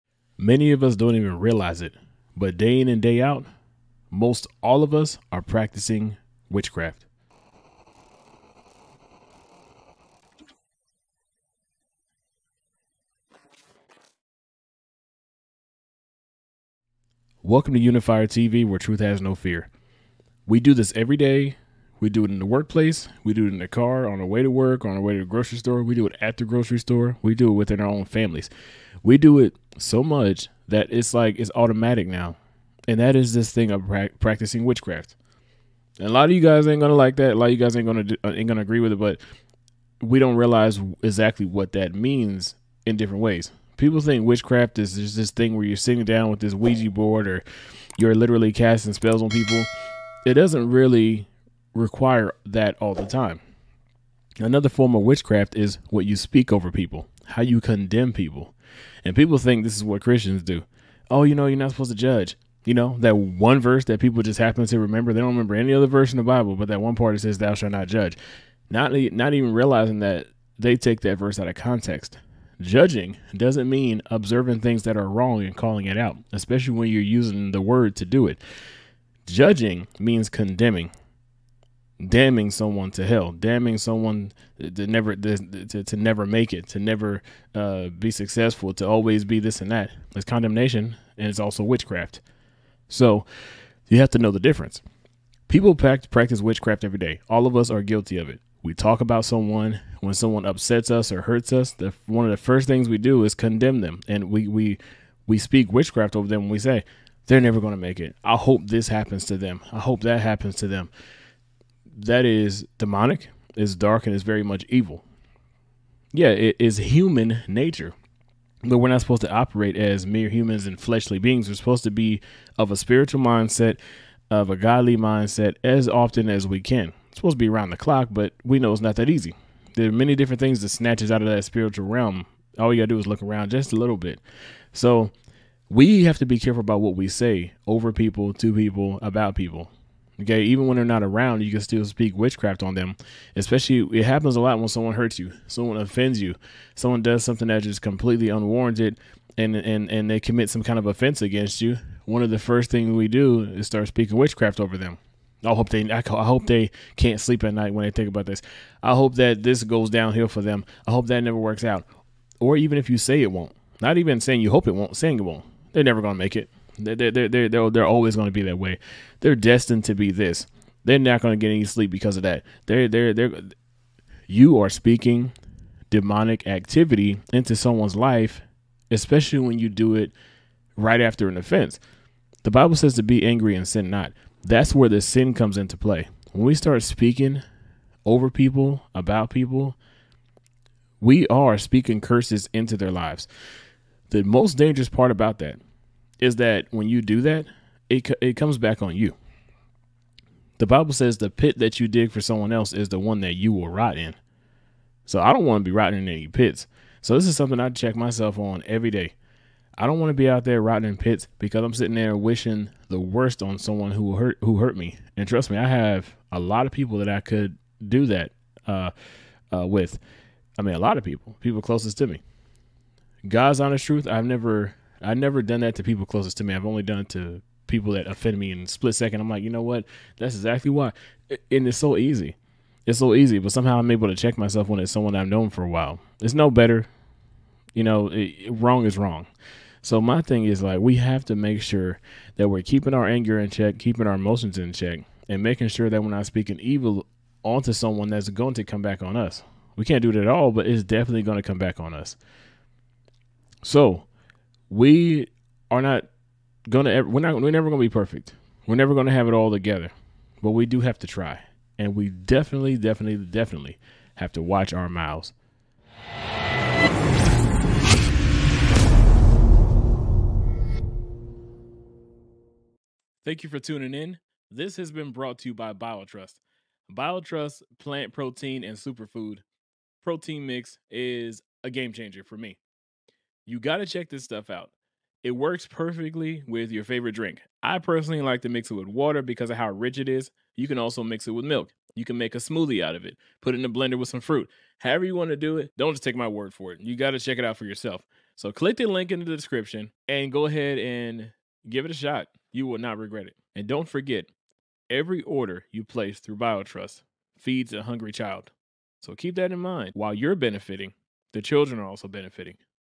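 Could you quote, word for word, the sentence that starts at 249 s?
We can't do it at all, but it's definitely going to come back on us.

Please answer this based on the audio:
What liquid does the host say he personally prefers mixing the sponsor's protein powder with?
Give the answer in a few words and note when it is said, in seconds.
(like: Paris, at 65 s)
water, at 288 s.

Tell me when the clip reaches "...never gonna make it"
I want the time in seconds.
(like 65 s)
165 s.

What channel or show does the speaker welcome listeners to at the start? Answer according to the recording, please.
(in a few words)
Unifier TV.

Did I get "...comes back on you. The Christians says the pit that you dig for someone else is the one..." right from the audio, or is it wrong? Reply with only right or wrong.
wrong.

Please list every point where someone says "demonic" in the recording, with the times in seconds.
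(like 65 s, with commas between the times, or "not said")
112 s, 175 s.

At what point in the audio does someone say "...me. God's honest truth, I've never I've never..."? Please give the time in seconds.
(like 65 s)
222 s.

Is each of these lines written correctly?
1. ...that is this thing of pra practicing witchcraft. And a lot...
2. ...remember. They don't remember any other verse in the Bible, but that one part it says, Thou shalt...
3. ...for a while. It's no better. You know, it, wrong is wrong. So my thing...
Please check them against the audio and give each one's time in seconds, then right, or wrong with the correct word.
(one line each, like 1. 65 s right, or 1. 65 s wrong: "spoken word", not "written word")
1. 32 s right
2. 64 s right
3. 235 s right.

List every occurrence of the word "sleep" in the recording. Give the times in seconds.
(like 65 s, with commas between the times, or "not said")
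157 s, 171 s.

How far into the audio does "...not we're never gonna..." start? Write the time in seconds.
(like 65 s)
257 s.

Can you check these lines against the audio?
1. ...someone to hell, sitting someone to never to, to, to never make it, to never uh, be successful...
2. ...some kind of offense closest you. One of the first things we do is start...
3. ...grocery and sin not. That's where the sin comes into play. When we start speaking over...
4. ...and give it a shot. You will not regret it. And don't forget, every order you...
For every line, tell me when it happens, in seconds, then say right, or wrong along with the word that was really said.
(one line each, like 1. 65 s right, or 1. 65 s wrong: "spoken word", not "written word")
1. 82 s wrong: "damning", not "sitting"
2. 150 s wrong: "against", not "closest"
3. 183 s wrong: "angry", not "grocery"
4. 300 s right.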